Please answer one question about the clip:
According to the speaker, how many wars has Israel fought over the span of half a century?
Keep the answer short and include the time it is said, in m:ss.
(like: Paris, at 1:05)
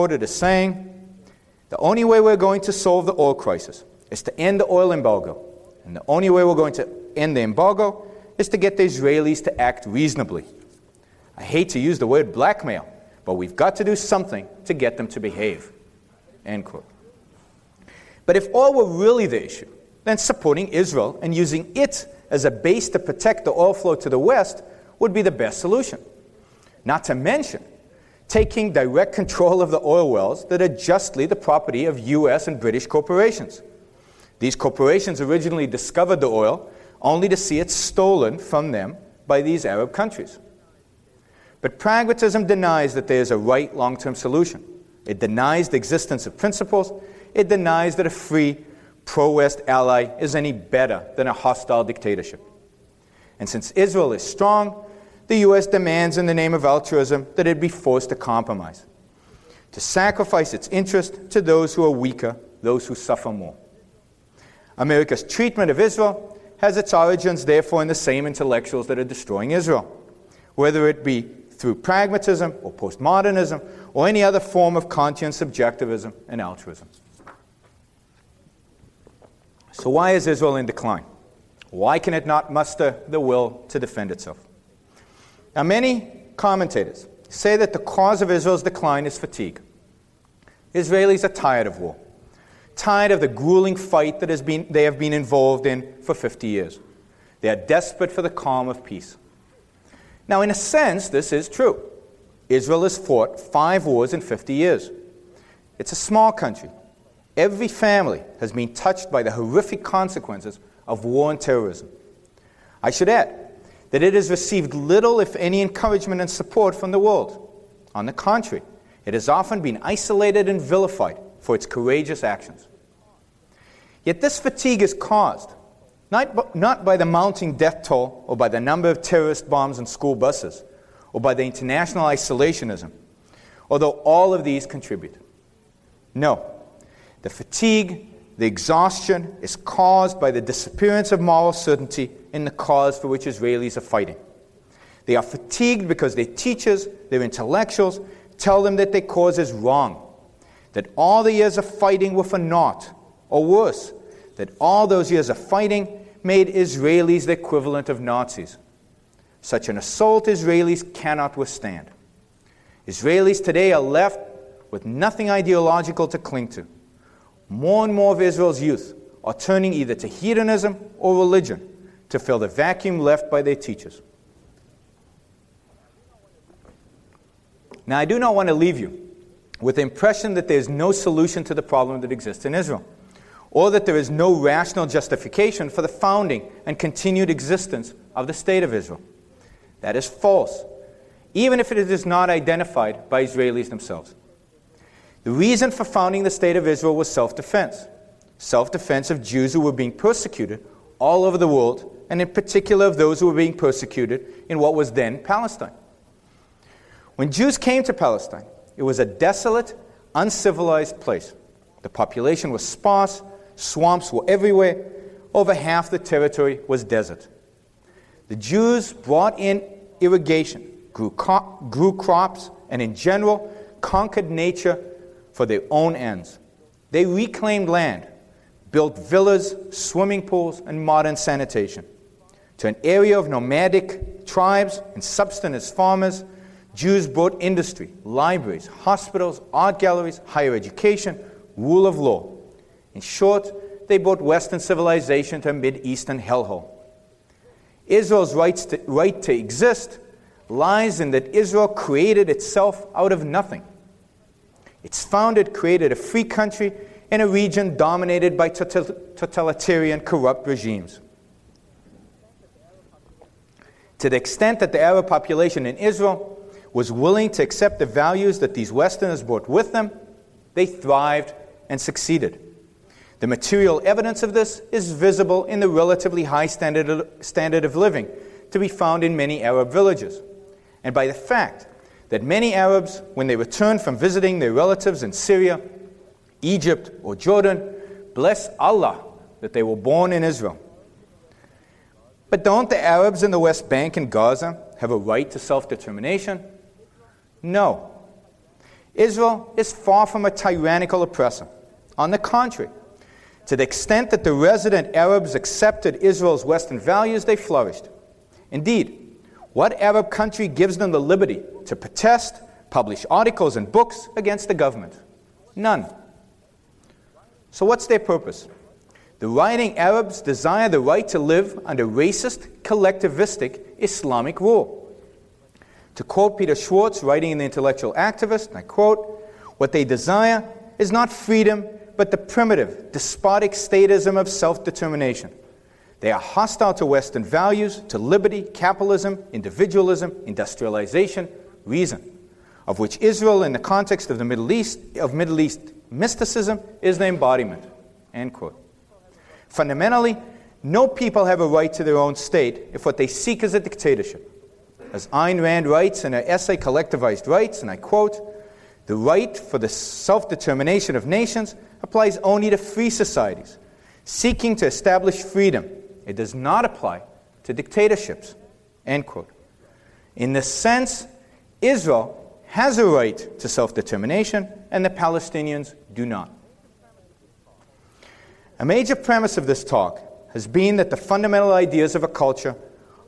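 5, at 1:43.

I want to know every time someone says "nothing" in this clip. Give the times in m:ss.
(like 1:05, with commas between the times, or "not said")
2:44, 4:13.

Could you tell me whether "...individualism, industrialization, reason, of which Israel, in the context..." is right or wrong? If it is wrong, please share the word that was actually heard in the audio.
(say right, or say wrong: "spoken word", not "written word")
right.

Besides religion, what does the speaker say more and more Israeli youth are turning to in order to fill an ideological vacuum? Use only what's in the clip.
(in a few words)
hedonism.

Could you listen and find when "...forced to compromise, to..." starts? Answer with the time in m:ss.
0:57.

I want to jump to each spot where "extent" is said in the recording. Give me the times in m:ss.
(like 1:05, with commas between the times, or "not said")
4:24, 5:03.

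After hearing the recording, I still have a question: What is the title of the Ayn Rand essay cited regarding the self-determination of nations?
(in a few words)
Collectivized Rights.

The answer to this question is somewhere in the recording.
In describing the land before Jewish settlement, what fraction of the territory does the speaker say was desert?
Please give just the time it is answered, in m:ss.
3:35.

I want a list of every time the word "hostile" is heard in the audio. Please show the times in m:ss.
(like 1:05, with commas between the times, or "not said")
0:51, 5:36.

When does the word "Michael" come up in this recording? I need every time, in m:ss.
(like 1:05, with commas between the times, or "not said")
not said.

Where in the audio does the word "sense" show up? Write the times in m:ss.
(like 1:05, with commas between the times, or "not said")
1:40, 6:10.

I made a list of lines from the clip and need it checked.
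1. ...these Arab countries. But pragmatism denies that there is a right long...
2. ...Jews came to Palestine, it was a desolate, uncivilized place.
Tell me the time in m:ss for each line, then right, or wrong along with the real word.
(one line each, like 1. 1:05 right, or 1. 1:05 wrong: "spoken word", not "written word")
1. 0:39 right
2. 3:27 right.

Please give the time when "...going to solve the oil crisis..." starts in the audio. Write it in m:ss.
0:02.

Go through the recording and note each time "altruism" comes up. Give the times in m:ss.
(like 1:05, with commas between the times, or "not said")
0:56, 1:16.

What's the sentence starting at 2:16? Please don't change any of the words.
No, the fatigue, the exhaustion is caused by the disappearance of moral certainty in the cause for which Israelis are fighting.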